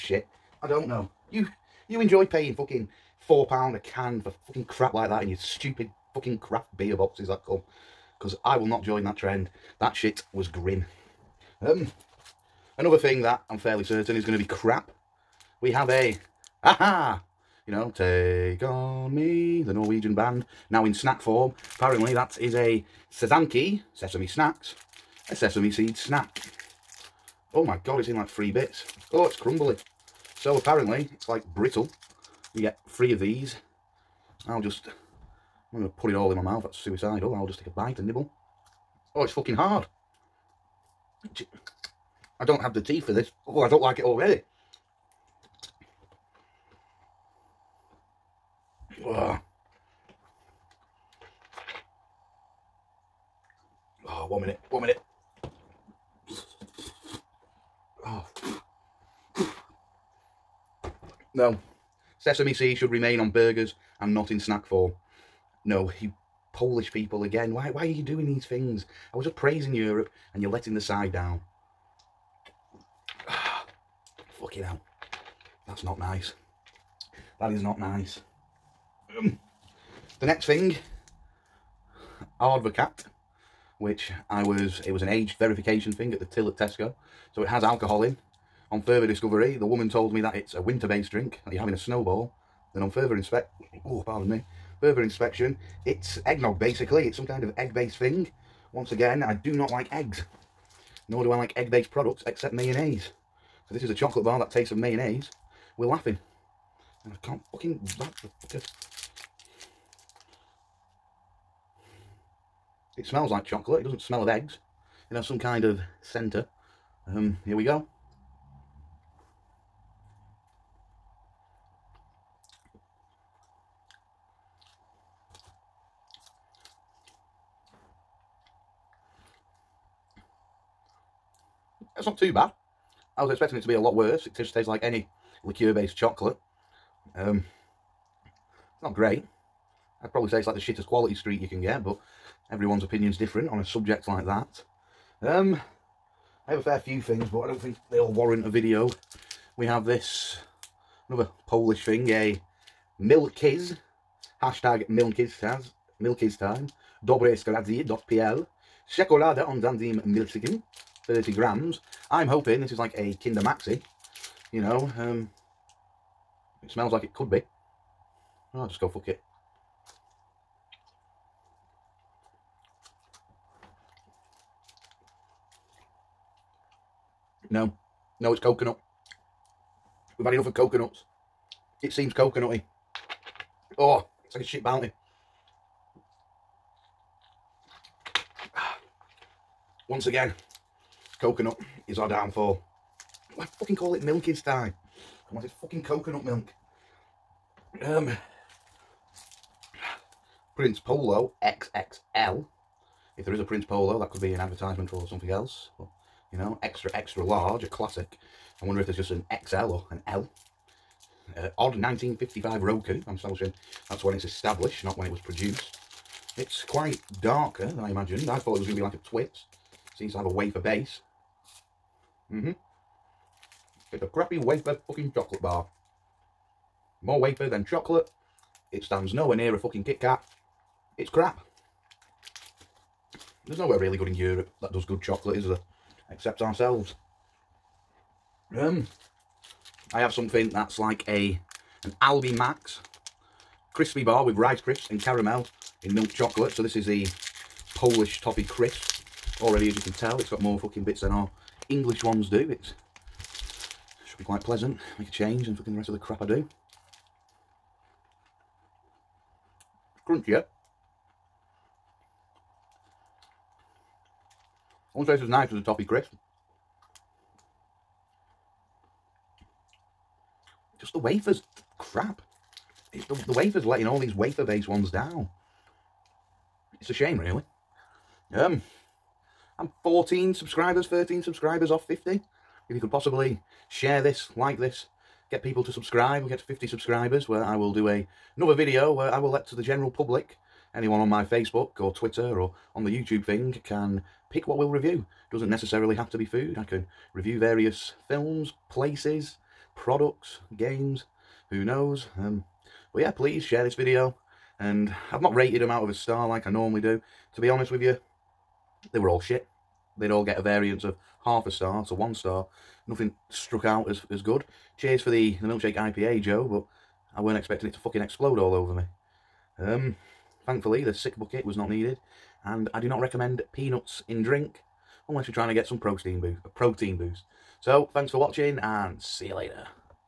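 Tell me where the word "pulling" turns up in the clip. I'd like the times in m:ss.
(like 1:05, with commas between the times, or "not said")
not said.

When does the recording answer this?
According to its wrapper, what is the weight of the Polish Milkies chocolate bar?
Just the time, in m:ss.
2:41.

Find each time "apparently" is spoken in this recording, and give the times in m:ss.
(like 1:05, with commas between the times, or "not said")
0:21, 0:30.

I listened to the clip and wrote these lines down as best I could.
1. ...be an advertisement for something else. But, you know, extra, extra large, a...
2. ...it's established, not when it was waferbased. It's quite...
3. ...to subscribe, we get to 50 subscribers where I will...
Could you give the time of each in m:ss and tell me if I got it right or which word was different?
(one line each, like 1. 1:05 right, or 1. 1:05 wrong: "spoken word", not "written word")
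1. 3:24 right
2. 3:34 wrong: "produced", not "waferbased"
3. 4:45 right.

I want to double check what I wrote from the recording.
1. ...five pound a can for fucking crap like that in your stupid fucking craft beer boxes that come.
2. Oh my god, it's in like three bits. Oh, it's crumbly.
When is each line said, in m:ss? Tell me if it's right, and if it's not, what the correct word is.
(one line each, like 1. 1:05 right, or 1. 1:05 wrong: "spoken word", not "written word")
1. 0:03 wrong: "four", not "five"
2. 0:27 right.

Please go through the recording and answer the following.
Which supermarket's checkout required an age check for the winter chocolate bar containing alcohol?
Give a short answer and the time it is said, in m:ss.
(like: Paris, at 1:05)
Tesco, at 1:26.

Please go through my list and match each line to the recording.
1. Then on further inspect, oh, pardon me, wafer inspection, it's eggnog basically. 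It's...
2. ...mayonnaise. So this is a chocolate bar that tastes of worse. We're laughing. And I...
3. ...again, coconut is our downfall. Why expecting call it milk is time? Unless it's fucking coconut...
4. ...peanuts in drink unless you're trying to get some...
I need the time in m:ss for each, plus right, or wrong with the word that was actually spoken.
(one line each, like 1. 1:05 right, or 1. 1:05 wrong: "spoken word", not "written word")
1. 1:32 wrong: "further", not "wafer"
2. 1:42 wrong: "mayonnaise", not "worse"
3. 3:10 wrong: "fucking", not "expecting"
4. 5:23 right.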